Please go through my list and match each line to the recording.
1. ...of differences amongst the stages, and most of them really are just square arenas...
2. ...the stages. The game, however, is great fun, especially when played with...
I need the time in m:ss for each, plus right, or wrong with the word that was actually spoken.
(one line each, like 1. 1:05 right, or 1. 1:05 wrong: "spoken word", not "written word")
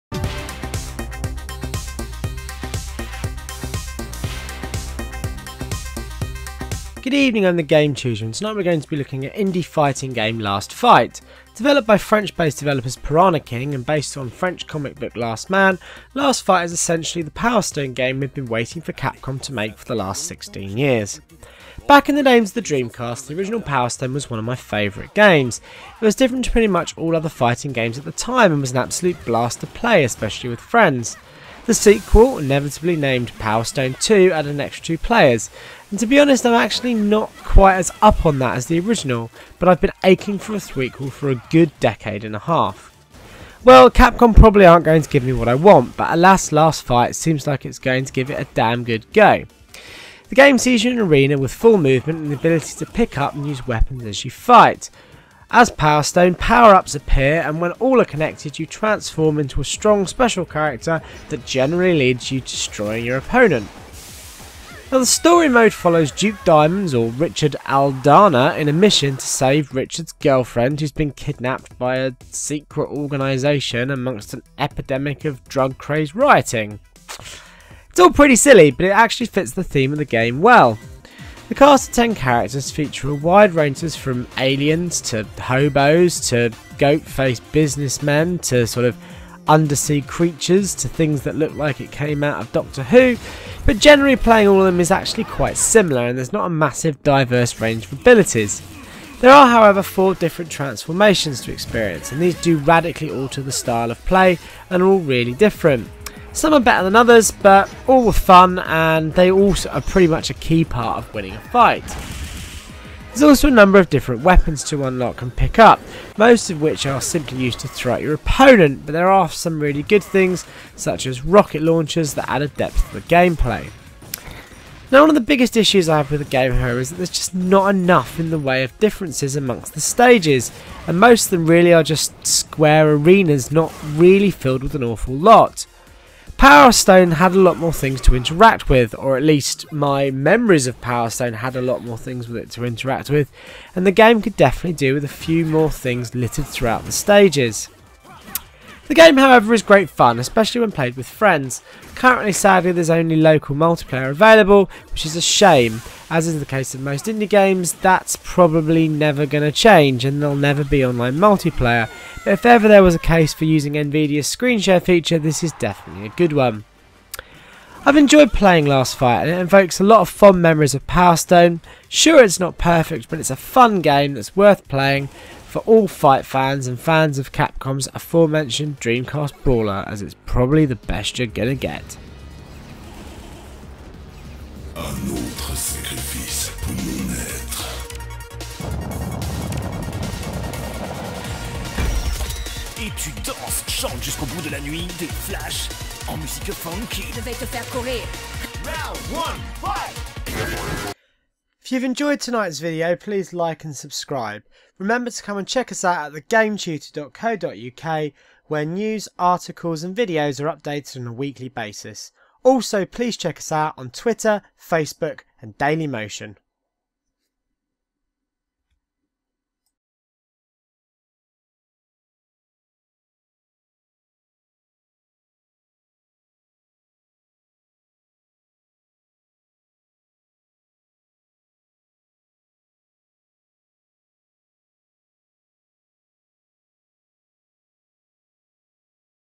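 1. 2:08 right
2. 2:26 right.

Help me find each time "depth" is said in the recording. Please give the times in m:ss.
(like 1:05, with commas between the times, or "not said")
2:02.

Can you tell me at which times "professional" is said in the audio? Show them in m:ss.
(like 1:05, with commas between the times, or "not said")
not said.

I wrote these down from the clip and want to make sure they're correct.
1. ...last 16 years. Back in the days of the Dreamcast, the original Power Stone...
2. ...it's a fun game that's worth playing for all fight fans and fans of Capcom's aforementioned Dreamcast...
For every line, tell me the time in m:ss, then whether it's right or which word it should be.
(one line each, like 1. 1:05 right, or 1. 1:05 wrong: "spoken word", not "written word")
1. 0:19 right
2. 2:53 right.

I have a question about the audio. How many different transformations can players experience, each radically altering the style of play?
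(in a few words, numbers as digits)
4.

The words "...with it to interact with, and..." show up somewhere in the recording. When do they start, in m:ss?
2:22.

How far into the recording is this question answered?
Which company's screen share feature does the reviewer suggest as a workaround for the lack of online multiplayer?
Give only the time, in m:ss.
2:43.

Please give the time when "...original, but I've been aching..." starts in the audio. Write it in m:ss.
0:38.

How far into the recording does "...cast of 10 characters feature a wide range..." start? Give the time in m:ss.
1:21.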